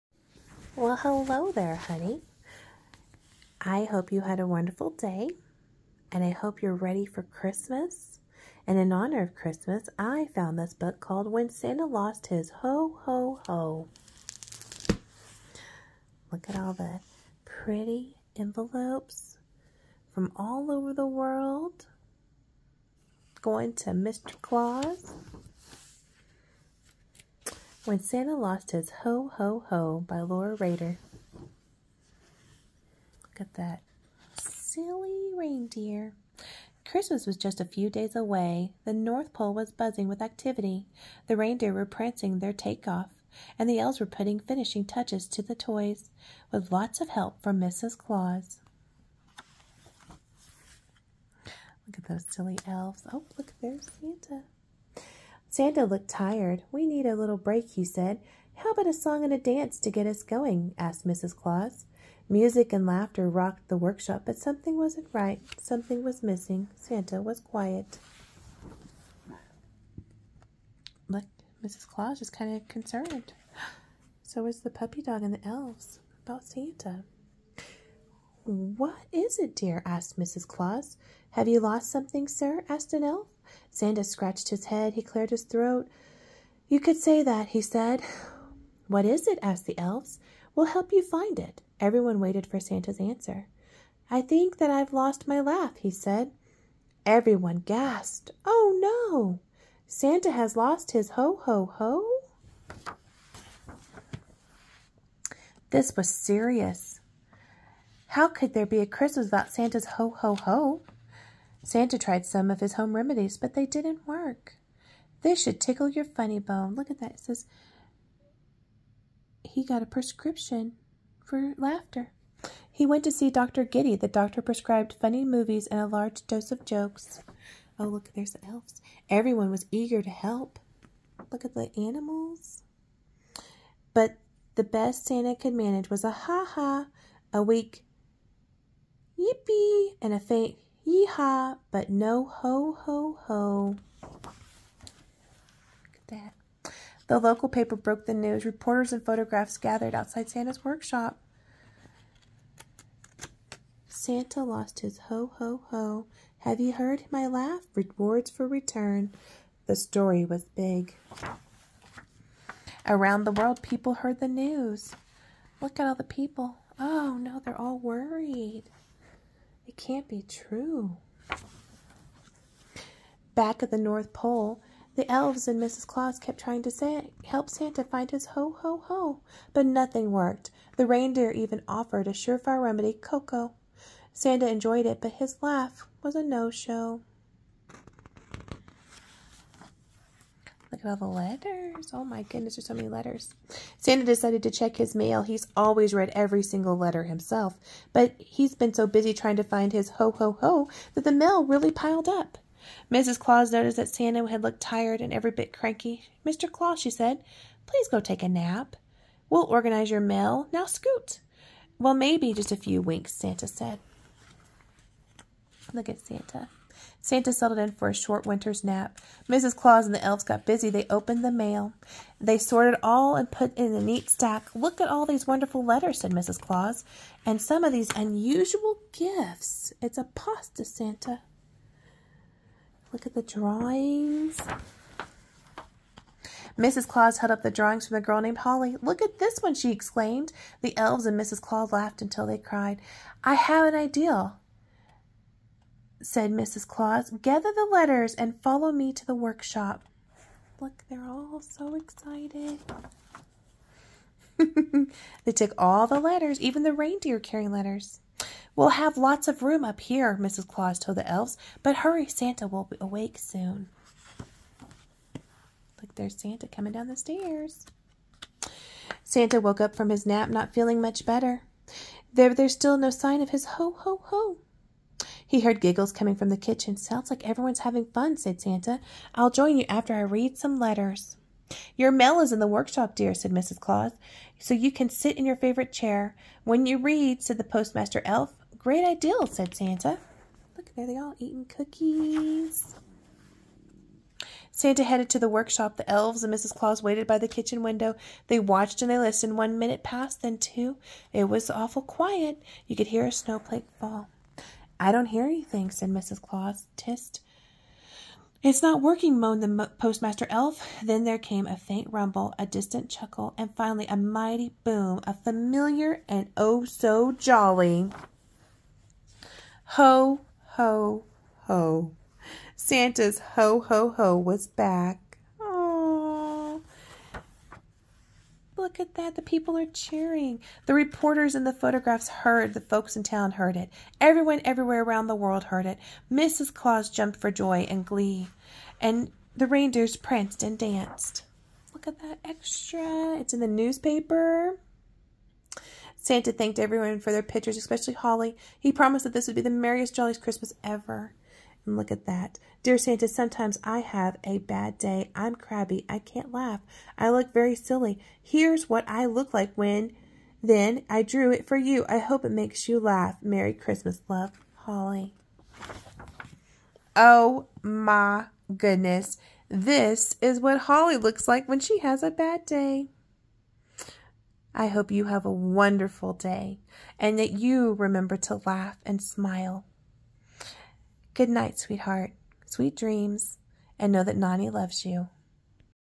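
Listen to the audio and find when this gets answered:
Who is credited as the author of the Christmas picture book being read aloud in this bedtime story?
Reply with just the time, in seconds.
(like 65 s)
30 s.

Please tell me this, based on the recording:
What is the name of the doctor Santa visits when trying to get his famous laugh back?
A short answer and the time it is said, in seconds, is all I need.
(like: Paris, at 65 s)
Dr. Giddy, at 123 s.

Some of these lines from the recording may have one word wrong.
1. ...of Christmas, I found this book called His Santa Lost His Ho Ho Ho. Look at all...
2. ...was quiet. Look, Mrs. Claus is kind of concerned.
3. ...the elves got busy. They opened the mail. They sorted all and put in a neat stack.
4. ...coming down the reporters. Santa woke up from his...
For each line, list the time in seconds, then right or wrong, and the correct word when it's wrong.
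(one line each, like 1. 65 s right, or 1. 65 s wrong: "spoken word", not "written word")
1. 9 s wrong: "When", not "His"
2. 67 s right
3. 219 s right
4. 266 s wrong: "stairs", not "reporters".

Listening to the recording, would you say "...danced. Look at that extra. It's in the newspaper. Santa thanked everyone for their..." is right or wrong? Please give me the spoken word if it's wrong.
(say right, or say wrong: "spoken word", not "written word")
right.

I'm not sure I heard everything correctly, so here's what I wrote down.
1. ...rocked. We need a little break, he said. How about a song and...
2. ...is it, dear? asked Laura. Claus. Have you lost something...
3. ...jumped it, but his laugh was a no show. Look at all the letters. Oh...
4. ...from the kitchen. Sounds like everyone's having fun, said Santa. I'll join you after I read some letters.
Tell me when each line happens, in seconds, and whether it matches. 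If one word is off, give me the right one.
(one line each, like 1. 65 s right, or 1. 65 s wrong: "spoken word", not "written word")
1. 56 s wrong: "tired", not "rocked"
2. 79 s wrong: "Mrs", not "Laura"
3. 184 s wrong: "enjoyed", not "jumped"
4. 276 s right.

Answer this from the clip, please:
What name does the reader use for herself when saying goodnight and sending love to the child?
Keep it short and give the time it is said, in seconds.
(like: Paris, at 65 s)
Nani, at 384 s.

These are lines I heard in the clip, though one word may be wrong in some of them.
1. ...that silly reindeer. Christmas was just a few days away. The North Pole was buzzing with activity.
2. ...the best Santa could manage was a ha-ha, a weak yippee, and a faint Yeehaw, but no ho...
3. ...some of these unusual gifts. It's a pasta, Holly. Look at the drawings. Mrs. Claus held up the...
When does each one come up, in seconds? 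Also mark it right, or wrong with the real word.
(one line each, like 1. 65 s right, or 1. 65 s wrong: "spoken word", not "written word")
1. 33 s right
2. 134 s right
3. 227 s wrong: "Santa", not "Holly".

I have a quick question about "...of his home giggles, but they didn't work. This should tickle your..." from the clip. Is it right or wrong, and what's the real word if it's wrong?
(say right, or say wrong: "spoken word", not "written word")
wrong: "remedies", not "giggles".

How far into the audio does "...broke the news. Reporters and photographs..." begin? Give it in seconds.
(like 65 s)
147 s.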